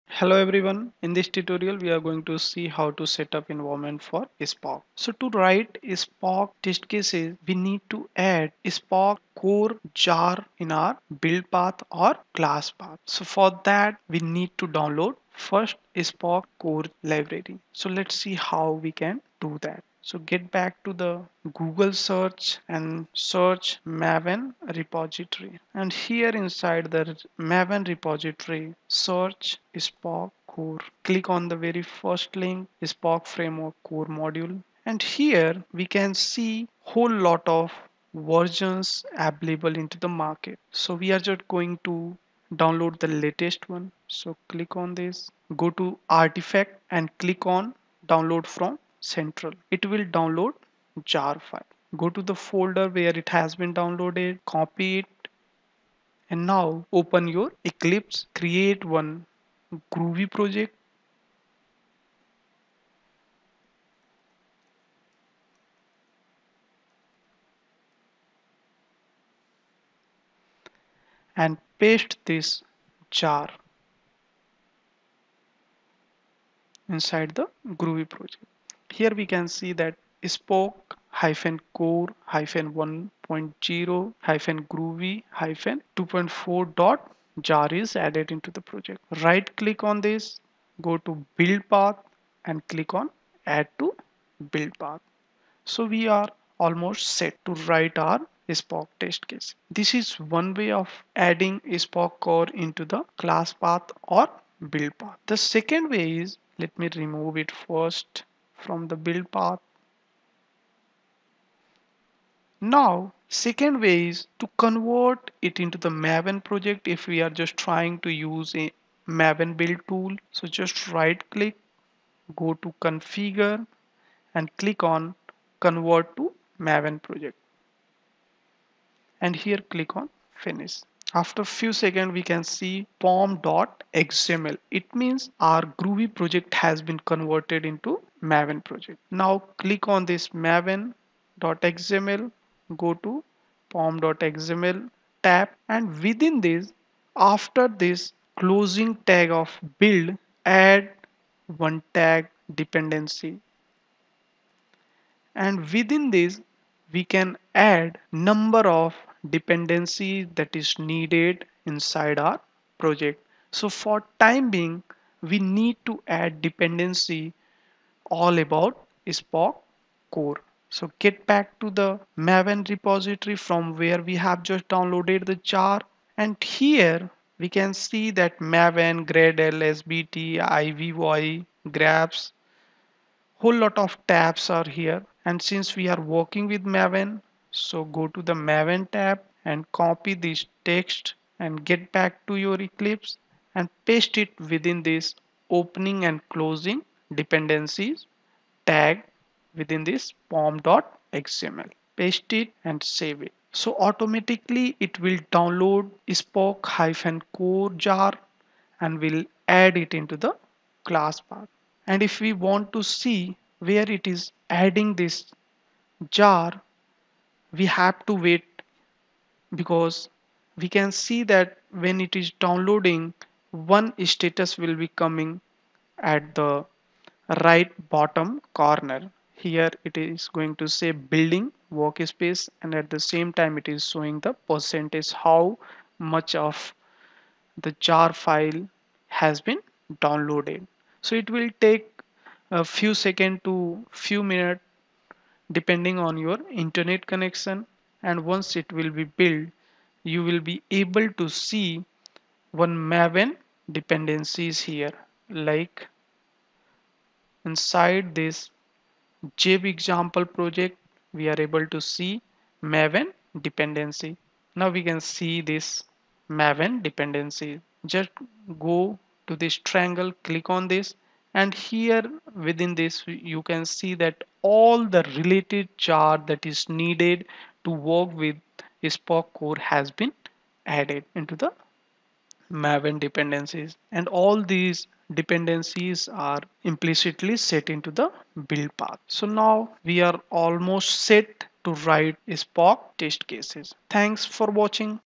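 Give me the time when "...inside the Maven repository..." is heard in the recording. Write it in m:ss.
0:26.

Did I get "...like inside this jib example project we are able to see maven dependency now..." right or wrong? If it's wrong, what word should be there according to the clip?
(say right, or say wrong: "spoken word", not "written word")
right.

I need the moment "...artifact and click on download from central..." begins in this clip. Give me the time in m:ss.
0:46.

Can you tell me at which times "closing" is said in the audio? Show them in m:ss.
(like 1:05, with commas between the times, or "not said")
2:28, 3:16.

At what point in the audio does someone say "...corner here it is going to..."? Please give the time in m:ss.
3:48.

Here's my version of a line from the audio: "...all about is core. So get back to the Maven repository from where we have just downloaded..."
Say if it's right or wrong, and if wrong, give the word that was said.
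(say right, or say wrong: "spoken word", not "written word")
right.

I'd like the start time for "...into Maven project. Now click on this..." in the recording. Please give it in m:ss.
2:17.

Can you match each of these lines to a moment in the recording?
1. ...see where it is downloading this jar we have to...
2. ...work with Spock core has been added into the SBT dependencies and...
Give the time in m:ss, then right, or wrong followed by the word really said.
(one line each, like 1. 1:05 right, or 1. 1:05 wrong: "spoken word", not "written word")
1. 3:32 wrong: "adding", not "downloading"
2. 4:37 wrong: "Maven", not "SBT".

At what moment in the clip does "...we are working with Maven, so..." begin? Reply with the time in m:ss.
3:05.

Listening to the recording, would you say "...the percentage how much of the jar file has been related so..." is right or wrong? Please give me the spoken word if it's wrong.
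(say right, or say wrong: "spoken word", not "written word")
wrong: "downloaded", not "related".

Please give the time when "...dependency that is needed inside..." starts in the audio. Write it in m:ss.
2:39.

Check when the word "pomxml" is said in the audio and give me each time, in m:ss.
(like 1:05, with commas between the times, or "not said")
2:12, 2:23, 3:20.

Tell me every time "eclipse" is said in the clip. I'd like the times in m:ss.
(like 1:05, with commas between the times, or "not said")
0:57, 3:12.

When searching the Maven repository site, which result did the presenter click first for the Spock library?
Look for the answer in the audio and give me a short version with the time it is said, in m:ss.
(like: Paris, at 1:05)
Spock Framework Core module, at 0:32.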